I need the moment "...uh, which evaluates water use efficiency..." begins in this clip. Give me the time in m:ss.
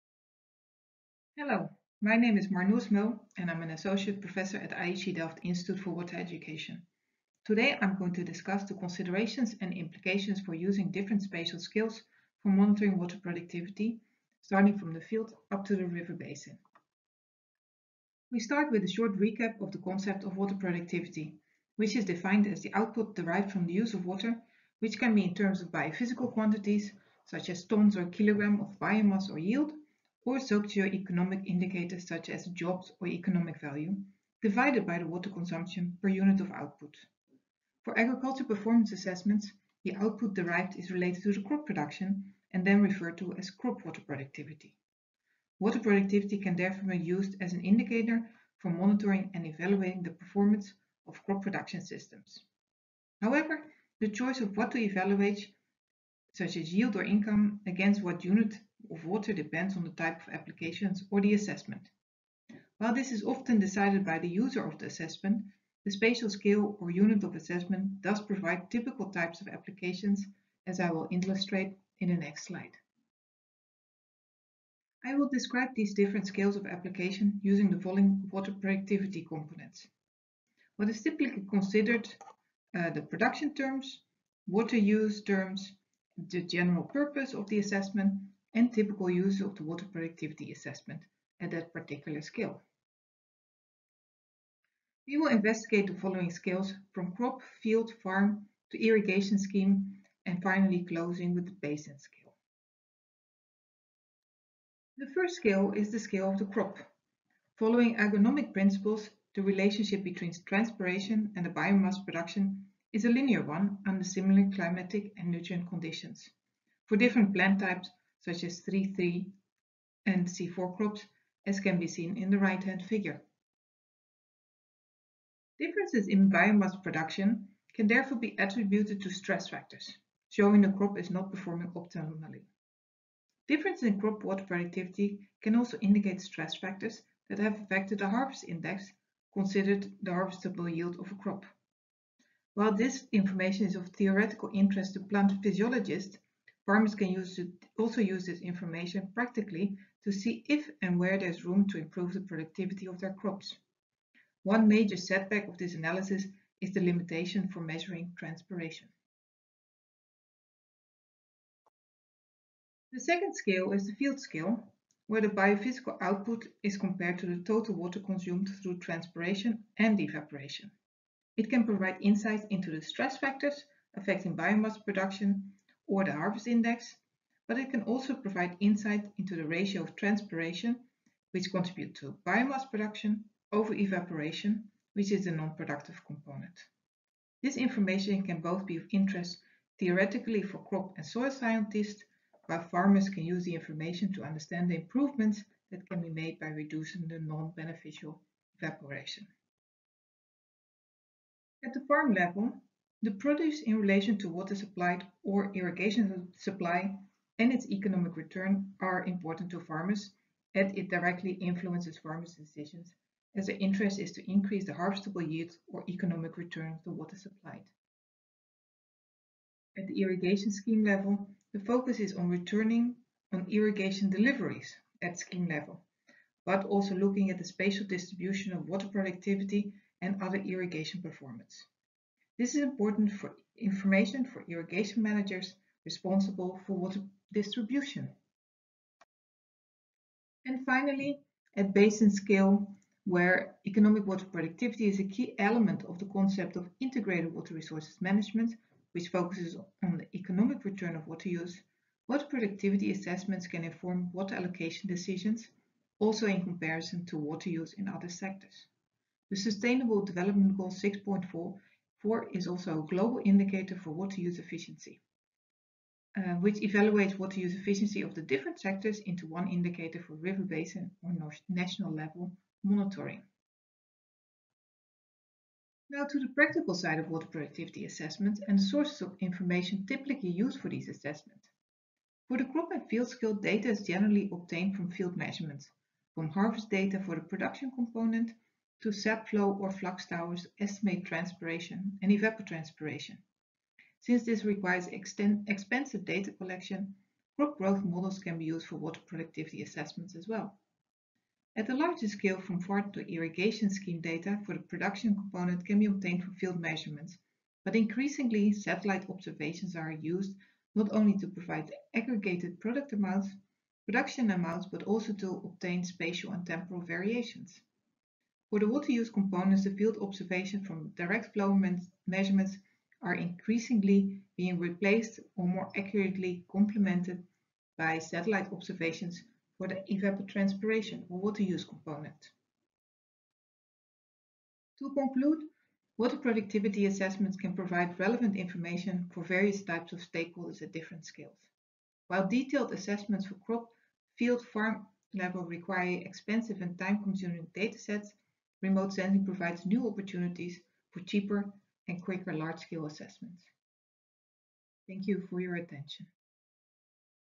4:26.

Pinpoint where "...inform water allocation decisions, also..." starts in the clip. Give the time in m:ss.
4:13.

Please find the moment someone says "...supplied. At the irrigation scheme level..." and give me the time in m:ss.
3:37.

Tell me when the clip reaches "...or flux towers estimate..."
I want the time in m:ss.
4:49.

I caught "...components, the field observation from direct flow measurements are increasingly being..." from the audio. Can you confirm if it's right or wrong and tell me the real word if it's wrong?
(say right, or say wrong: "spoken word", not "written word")
right.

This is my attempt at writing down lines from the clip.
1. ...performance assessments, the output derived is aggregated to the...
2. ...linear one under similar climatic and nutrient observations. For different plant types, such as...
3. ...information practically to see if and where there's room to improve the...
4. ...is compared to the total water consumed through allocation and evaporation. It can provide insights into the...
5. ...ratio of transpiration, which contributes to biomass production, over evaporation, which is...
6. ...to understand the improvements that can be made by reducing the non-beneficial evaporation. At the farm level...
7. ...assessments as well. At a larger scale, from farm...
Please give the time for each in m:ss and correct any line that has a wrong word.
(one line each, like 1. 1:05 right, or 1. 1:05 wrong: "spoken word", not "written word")
1. 0:38 wrong: "related", not "aggregated"
2. 1:53 wrong: "conditions", not "observations"
3. 2:28 right
4. 2:46 wrong: "transpiration", not "allocation"
5. 2:59 right
6. 3:14 right
7. 4:59 right.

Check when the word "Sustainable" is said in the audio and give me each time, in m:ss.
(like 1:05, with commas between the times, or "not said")
4:19.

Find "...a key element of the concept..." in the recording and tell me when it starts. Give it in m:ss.
4:04.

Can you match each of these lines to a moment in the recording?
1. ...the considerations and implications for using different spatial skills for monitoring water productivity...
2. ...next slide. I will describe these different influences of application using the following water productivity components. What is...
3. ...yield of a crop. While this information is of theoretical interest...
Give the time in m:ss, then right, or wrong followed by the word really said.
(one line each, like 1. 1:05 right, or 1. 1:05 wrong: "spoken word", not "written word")
1. 0:08 right
2. 1:12 wrong: "scales", not "influences"
3. 2:20 right.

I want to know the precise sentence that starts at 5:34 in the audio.
To conclude, water productivity assessments can provide relevant information for various types of stakeholders at different scales.